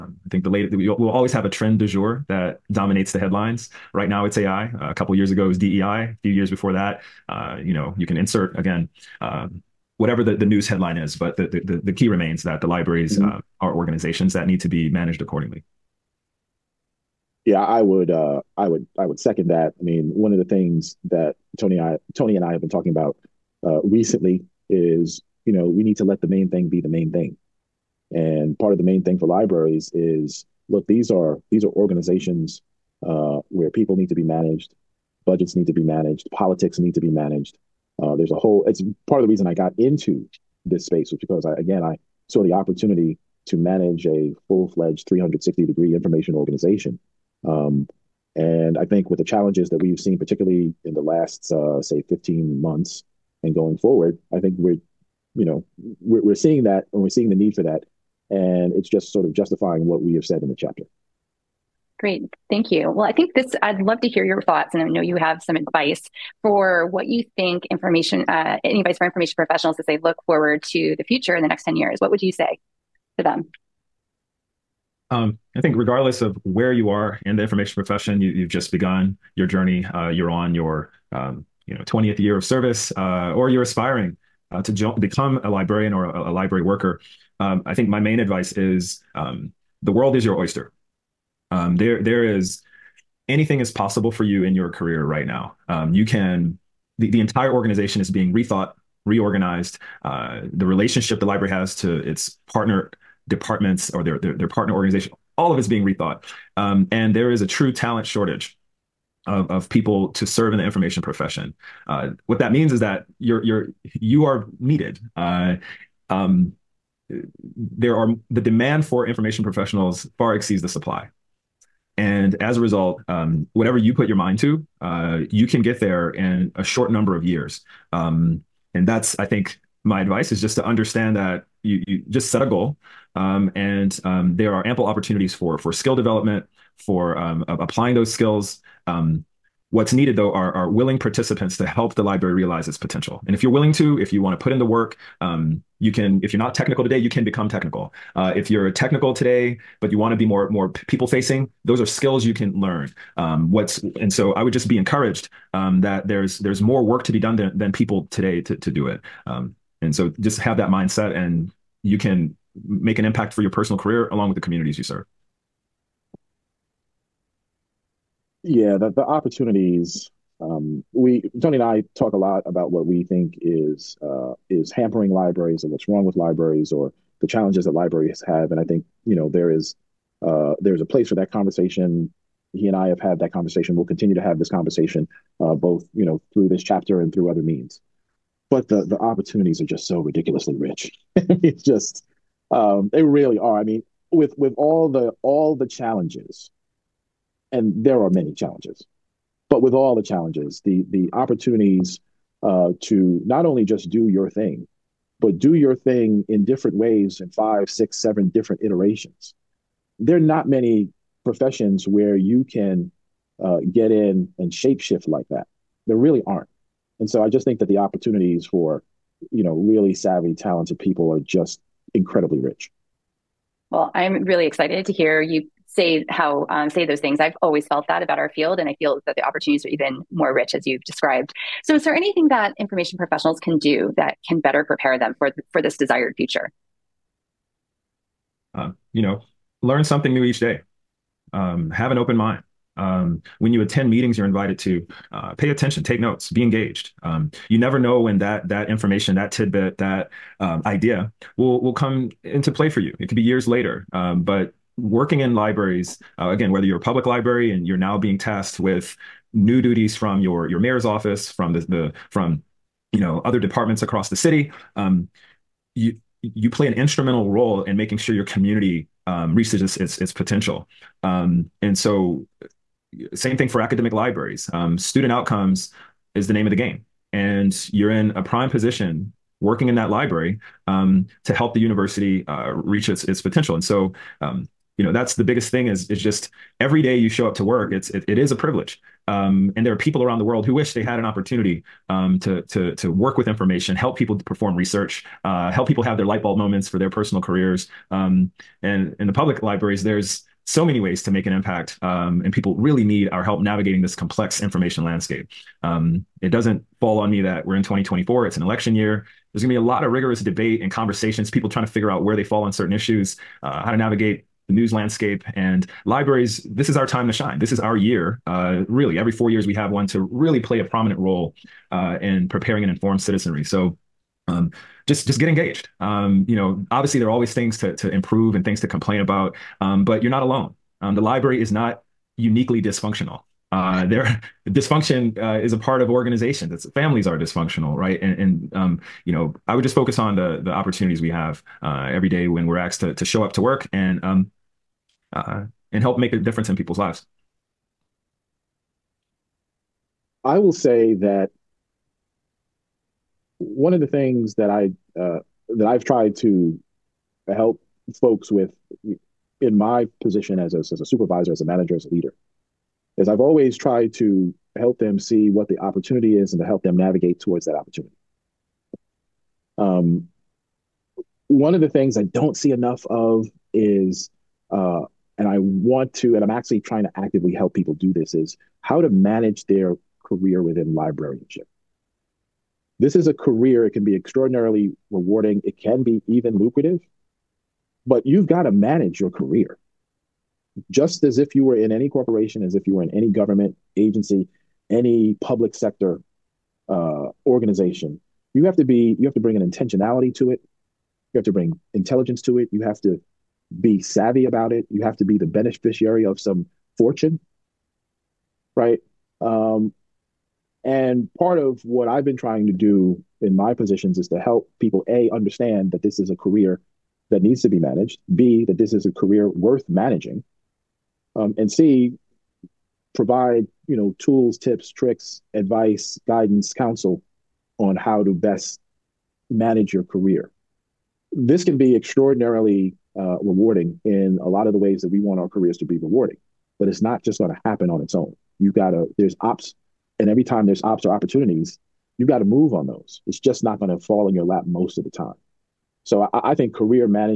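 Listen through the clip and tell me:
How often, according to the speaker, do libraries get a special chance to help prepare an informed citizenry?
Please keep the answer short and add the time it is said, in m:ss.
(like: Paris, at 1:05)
every 4 years, at 5:18.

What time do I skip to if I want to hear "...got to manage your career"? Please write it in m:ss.
6:28.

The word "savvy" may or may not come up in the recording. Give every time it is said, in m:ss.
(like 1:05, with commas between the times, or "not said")
3:39, 6:43.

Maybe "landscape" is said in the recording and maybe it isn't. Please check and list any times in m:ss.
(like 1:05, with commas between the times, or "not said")
5:04, 5:14.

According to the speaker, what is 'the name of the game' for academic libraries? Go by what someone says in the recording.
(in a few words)
Student outcomes.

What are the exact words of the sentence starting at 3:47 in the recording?
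I've always felt that about our field, and I feel that the opportunities are even more rich as you've described.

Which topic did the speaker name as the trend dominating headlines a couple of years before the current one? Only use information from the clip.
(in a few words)
DEI.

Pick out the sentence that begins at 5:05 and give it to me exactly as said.
Um, it doesn't fall on me that we're in 2024, it's an election year.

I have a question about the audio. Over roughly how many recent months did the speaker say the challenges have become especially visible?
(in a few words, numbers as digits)
15 months.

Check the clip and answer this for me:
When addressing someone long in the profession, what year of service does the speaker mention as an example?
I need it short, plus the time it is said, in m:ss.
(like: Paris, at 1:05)
20th year, at 1:21.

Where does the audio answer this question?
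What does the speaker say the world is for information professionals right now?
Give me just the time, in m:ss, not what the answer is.
1:30.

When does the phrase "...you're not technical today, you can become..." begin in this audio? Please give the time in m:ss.
2:26.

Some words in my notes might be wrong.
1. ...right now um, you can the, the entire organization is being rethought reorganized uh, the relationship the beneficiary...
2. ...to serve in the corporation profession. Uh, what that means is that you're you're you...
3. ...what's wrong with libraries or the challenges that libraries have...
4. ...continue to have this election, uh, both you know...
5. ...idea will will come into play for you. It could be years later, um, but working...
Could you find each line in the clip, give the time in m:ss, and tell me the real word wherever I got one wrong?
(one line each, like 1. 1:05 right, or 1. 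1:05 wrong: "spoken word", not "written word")
1. 1:35 wrong: "library", not "beneficiary"
2. 1:50 wrong: "information", not "corporation"
3. 2:55 right
4. 3:03 wrong: "conversation", not "election"
5. 4:10 right.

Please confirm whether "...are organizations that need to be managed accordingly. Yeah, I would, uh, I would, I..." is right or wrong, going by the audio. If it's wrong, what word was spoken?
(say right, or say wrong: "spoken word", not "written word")
right.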